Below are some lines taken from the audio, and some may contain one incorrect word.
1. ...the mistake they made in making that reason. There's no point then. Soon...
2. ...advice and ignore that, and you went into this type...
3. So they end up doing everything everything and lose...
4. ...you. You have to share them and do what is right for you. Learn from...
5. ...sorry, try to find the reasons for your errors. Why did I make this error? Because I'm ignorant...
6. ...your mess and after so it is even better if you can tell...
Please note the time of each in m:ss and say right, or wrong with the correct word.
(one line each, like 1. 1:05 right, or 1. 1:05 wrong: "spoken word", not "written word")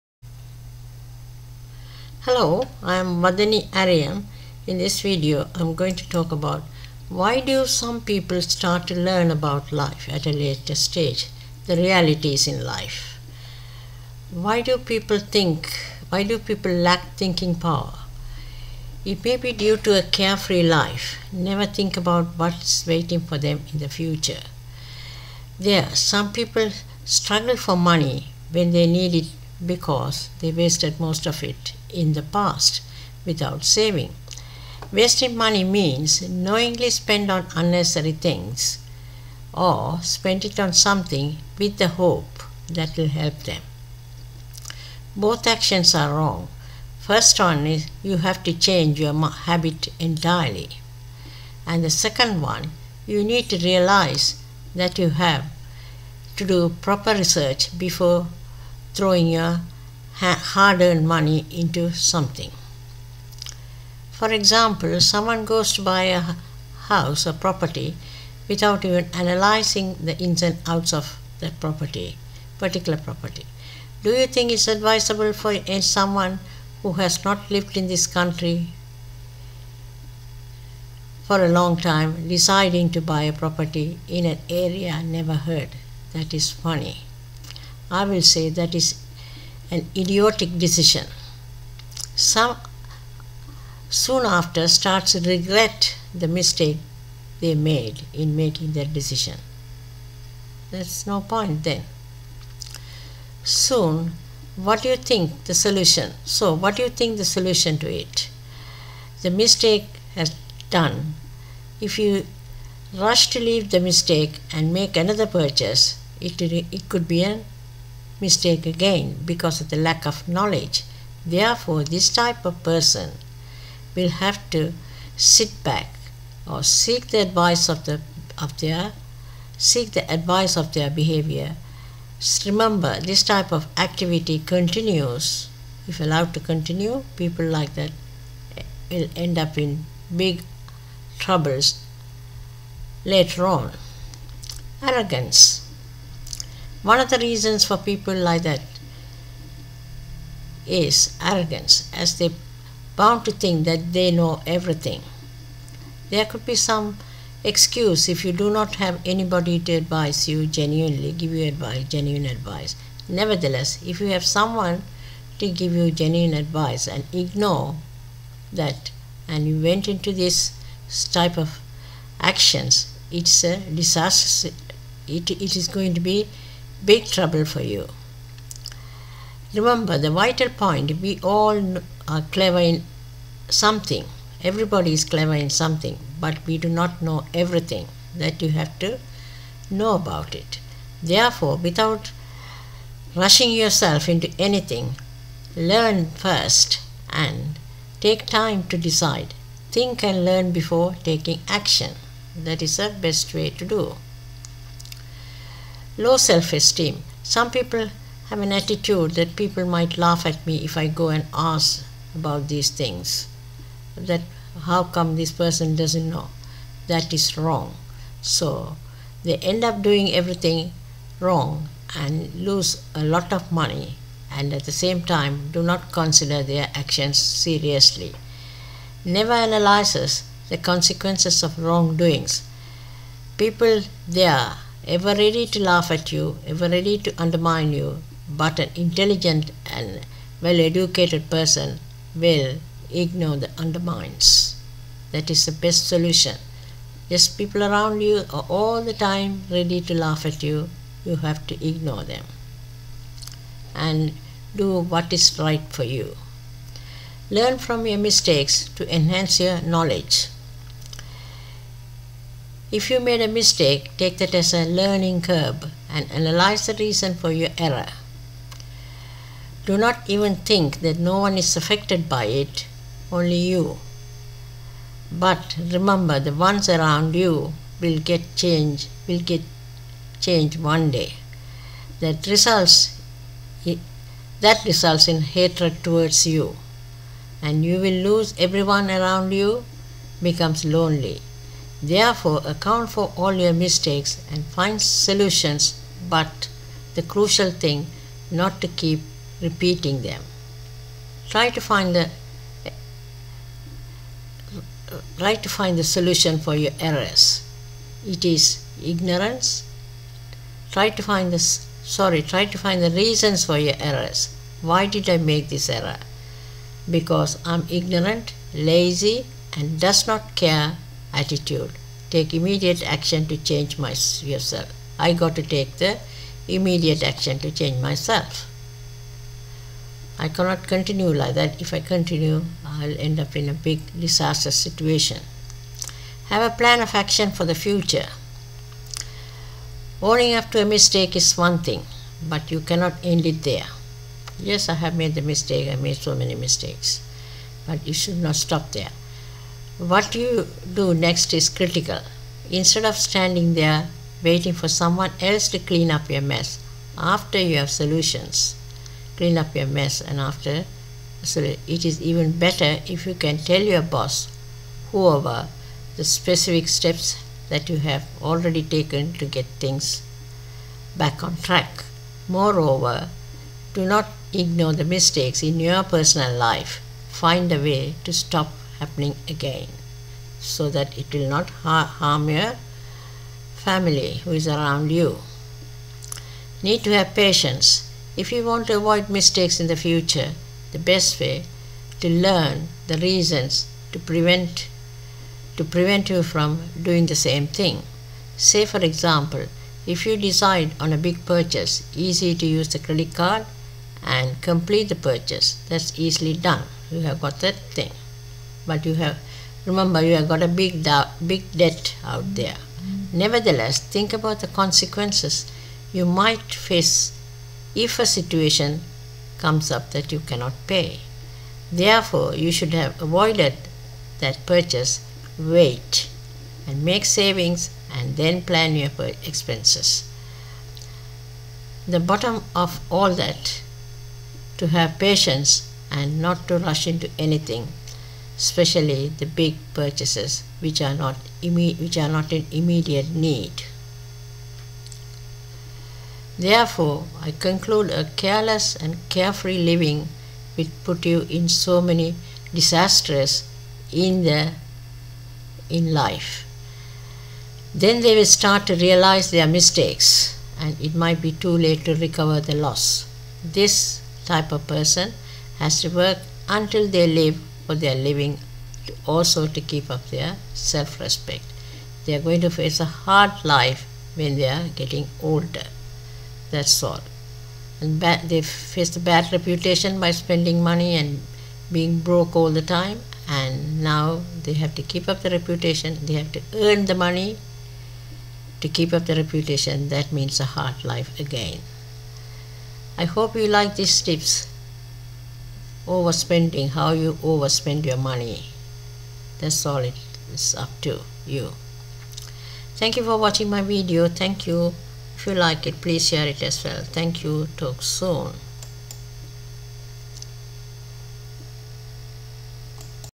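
1. 1:36 wrong: "decision", not "reason"
2. 2:46 right
3. 3:38 wrong: "wrong", not "everything"
4. 4:10 wrong: "ignore", not "share"
5. 5:11 right
6. 5:59 right.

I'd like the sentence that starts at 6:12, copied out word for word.
Moreover, do not ignore the mistakes in your personal life.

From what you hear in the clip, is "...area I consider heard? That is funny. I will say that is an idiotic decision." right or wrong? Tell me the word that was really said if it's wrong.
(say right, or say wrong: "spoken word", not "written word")
wrong: "never", not "consider".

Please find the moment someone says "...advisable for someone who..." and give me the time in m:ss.
1:14.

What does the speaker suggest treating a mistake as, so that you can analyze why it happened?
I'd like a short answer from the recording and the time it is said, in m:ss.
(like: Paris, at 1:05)
A learning curve, at 4:24.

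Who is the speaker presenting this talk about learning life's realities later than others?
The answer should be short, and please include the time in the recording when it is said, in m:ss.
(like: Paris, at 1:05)
Vathani Ariyam, at 0:03.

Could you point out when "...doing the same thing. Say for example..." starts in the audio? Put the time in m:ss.
6:36.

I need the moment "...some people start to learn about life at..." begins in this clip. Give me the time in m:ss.
0:07.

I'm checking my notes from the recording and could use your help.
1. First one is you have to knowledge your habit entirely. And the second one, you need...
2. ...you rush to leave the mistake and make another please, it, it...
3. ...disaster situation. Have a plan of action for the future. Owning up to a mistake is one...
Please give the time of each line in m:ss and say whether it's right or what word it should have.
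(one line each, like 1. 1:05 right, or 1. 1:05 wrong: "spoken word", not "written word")
1. 0:46 wrong: "change", not "knowledge"
2. 1:51 wrong: "purchase", not "please"
3. 5:33 right.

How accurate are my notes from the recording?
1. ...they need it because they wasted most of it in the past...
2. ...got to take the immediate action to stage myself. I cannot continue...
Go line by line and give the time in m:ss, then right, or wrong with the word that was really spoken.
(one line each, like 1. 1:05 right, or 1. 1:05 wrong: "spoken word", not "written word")
1. 0:28 right
2. 5:25 wrong: "change", not "stage".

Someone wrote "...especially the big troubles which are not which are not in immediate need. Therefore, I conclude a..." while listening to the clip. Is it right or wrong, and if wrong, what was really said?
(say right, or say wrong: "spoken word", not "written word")
wrong: "purchases", not "troubles".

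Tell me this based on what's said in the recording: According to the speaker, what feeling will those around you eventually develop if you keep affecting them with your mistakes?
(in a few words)
Hatred.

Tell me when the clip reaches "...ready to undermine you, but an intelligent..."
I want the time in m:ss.
3:56.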